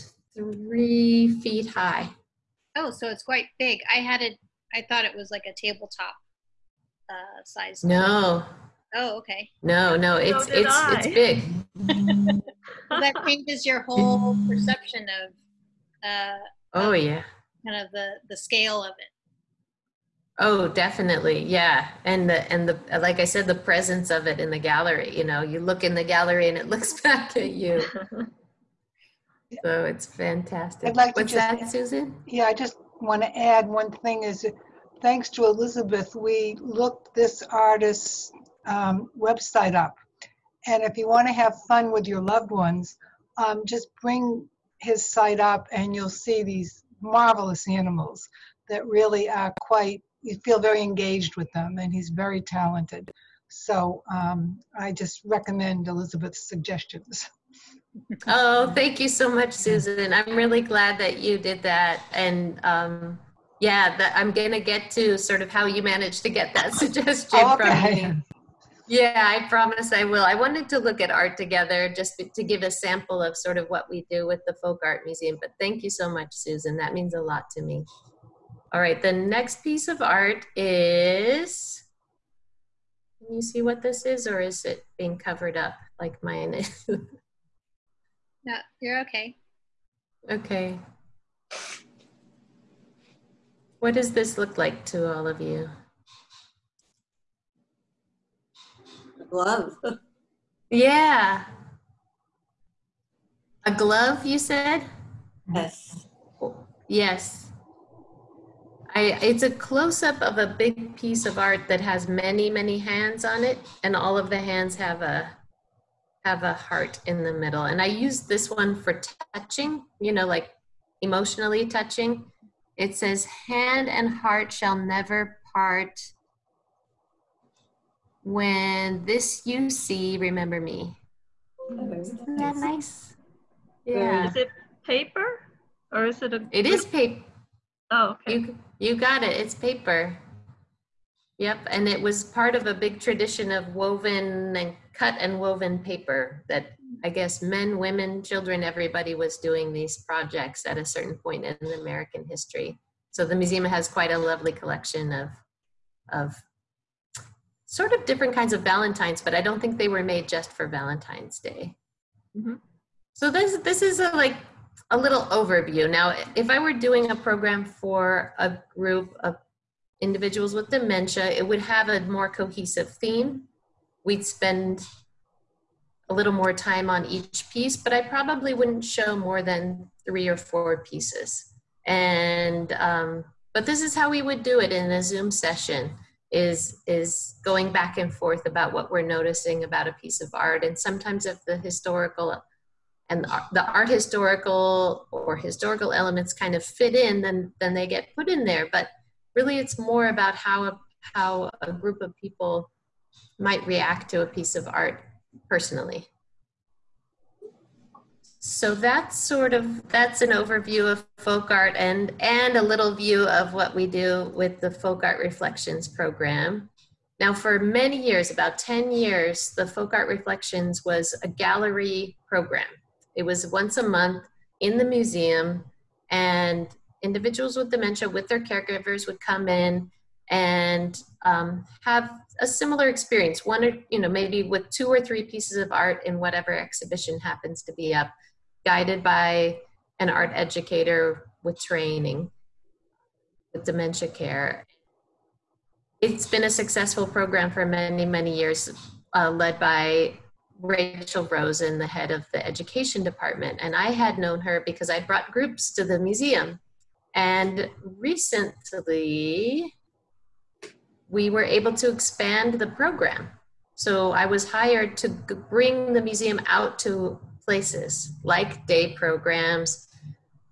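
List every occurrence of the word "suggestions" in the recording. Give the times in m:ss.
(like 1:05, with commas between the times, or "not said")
0:56, 1:06.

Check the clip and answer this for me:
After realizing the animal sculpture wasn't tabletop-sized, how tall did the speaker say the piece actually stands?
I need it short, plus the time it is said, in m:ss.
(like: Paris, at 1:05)
3 feet, at 0:00.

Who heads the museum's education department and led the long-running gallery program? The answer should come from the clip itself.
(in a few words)
Rachel Rosen.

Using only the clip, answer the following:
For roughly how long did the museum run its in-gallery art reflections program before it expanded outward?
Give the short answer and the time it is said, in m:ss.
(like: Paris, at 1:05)
10 years, at 3:38.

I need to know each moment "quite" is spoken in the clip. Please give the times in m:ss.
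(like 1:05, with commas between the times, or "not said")
0:03, 0:49, 2:33.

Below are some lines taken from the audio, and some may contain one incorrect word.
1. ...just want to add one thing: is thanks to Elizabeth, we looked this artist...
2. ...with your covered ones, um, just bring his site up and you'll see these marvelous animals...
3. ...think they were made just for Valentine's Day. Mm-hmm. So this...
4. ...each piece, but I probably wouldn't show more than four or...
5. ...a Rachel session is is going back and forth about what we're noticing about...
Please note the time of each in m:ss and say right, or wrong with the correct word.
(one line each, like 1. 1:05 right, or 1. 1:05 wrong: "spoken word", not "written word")
1. 0:32 right
2. 0:41 wrong: "loved", not "covered"
3. 2:39 right
4. 2:57 wrong: "three", not "four"
5. 3:04 wrong: "Zoom", not "Rachel".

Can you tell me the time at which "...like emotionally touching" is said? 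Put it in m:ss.
2:00.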